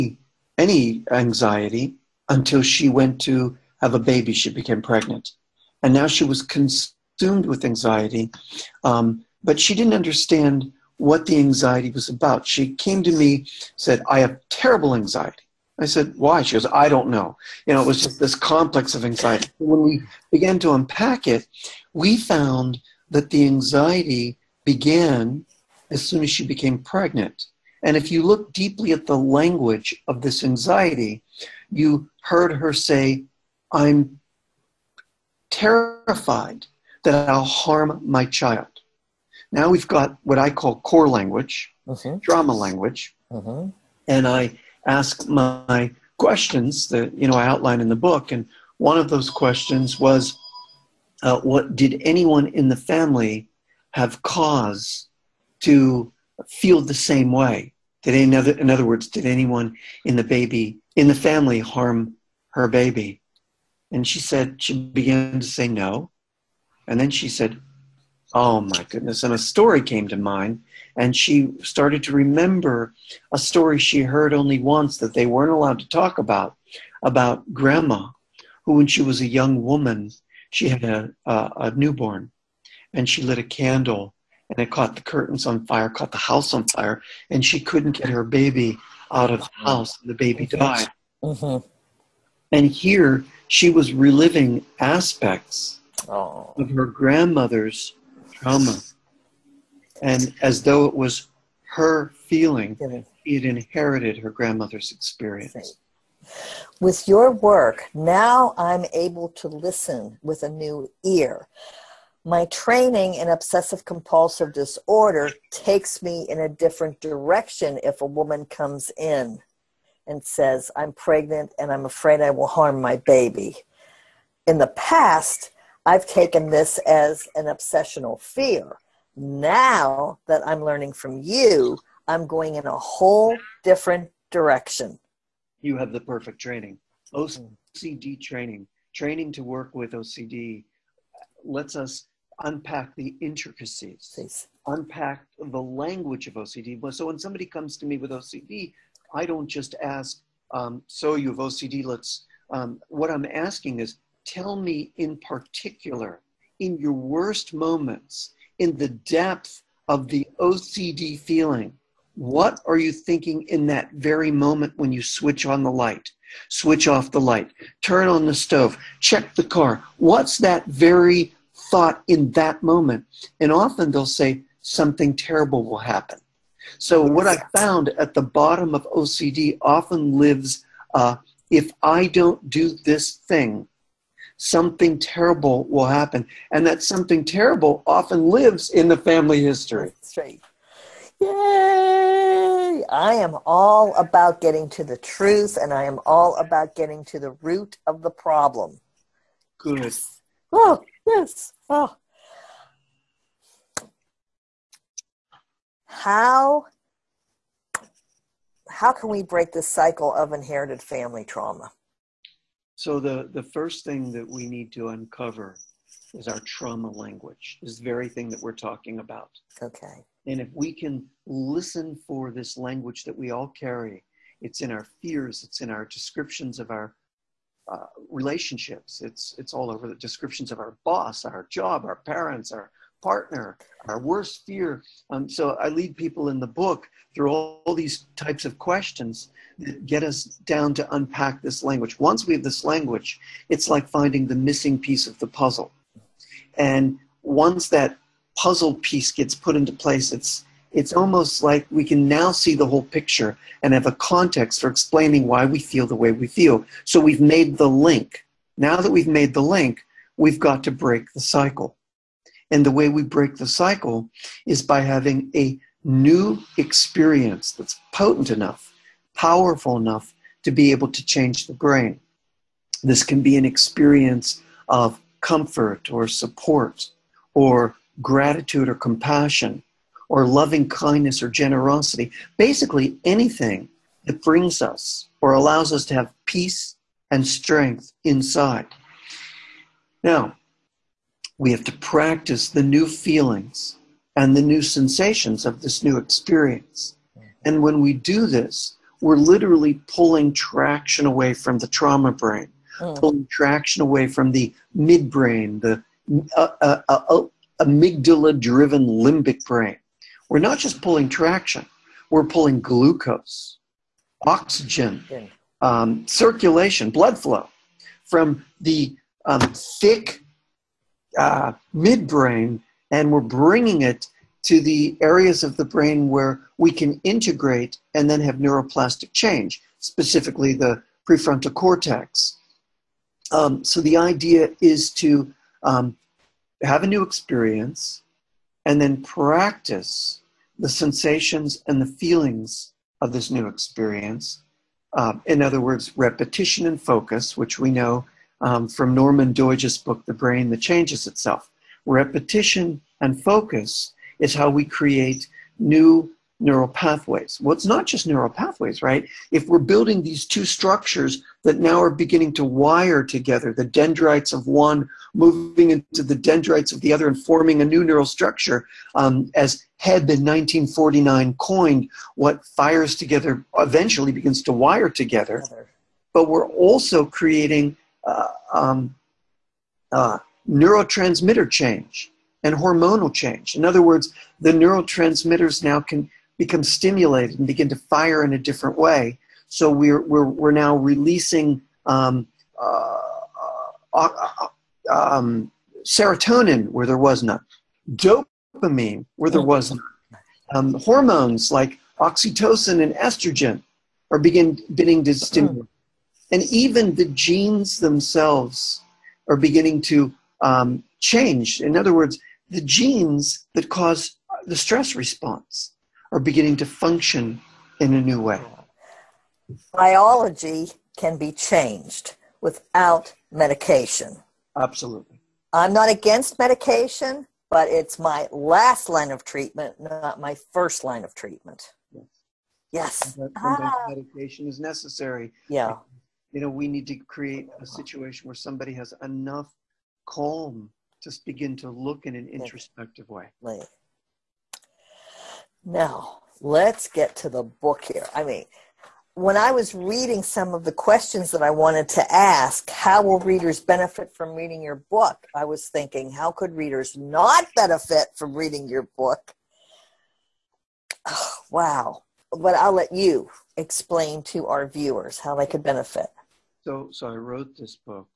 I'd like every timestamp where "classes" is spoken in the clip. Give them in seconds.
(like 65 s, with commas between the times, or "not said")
not said.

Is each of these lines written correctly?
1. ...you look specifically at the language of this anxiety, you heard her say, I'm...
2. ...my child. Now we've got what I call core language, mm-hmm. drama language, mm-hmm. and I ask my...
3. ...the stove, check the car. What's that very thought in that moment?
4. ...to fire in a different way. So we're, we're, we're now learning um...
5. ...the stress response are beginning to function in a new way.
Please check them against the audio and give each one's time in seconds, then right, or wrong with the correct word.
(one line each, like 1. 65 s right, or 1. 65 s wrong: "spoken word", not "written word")
1. 28 s wrong: "deeply", not "specifically"
2. 38 s right
3. 168 s right
4. 387 s wrong: "releasing", not "learning"
5. 414 s right.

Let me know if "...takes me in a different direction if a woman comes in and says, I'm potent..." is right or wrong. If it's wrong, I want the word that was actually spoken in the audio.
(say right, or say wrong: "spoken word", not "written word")
wrong: "pregnant", not "potent".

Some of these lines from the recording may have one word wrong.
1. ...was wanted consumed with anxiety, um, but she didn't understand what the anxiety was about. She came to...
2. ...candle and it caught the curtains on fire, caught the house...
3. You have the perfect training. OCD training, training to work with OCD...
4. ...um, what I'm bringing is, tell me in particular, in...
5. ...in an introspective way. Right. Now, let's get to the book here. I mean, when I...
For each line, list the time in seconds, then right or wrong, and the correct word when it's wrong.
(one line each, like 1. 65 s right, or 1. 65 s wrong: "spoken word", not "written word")
1. 6 s wrong: "concerned", not "wanted"
2. 83 s right
3. 135 s right
4. 152 s wrong: "asking", not "bringing"
5. 442 s right.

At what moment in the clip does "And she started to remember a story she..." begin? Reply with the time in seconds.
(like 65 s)
70 s.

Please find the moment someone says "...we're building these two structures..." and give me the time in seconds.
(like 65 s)
359 s.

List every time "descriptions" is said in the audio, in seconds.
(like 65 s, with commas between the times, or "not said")
225 s, 229 s.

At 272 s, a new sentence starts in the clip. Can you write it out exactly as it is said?
This can be an experience of comfort or support or gratitude or compassion or loving kindness or generosity.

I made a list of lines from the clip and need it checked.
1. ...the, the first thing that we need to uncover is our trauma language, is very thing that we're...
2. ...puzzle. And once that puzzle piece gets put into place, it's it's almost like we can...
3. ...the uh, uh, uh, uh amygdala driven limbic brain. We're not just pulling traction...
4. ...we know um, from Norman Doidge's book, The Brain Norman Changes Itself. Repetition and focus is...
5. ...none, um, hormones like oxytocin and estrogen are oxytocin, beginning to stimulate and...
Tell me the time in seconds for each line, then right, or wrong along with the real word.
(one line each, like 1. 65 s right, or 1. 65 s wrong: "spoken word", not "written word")
1. 212 s right
2. 245 s right
3. 305 s right
4. 347 s wrong: "That", not "Norman"
5. 399 s wrong: "begin", not "oxytocin".